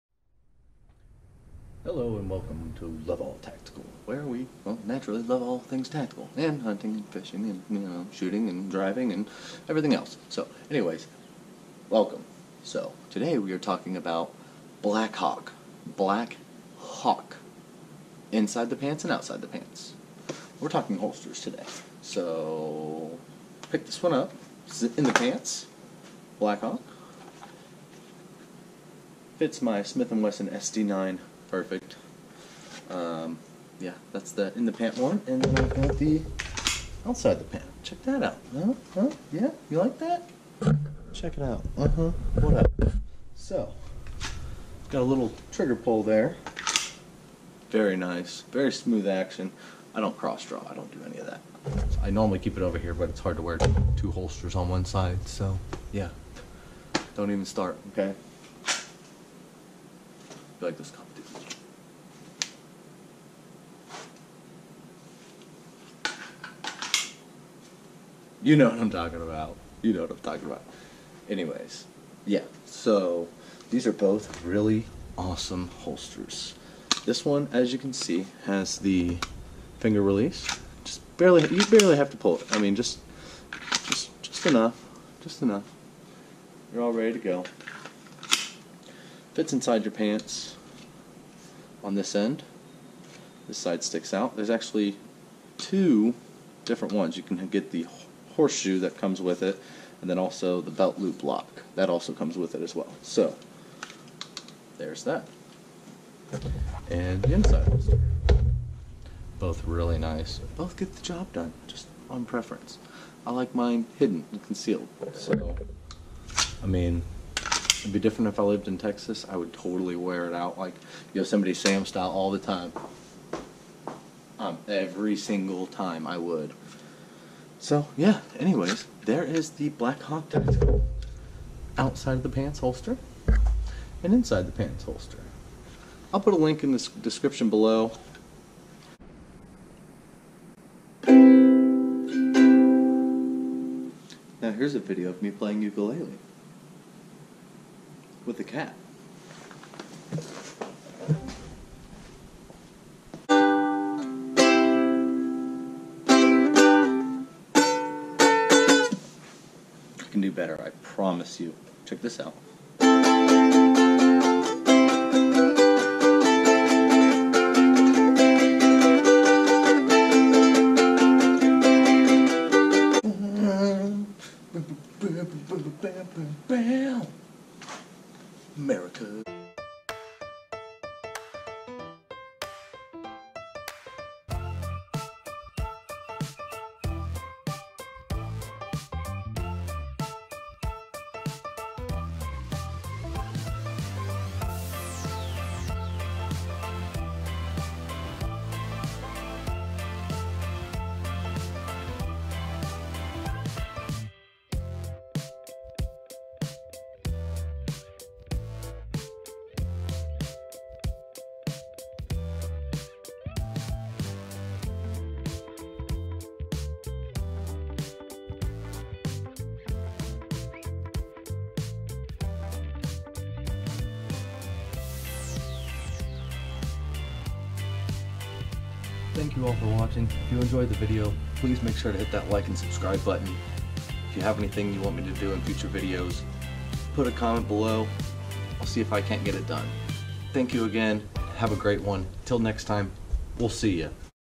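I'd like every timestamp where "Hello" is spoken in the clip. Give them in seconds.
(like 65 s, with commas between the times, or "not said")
1 s.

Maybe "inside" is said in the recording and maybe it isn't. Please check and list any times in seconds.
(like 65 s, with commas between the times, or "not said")
18 s, 89 s, 107 s, 134 s.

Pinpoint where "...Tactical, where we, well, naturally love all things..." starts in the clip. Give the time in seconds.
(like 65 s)
3 s.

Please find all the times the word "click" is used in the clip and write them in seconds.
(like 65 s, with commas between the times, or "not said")
not said.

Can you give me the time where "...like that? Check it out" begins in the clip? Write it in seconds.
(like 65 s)
39 s.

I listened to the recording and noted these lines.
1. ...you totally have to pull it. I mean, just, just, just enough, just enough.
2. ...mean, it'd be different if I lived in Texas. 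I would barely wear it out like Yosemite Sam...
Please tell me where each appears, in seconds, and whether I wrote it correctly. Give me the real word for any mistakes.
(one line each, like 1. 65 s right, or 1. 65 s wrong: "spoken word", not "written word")
1. 81 s wrong: "barely", not "totally"
2. 116 s wrong: "totally", not "barely".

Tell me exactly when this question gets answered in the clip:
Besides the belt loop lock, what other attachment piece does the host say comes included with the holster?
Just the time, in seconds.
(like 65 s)
98 s.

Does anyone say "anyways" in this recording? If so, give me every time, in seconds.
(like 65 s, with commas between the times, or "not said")
10 s, 71 s, 128 s.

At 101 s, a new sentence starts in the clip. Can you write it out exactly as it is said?
That also comes with it as well.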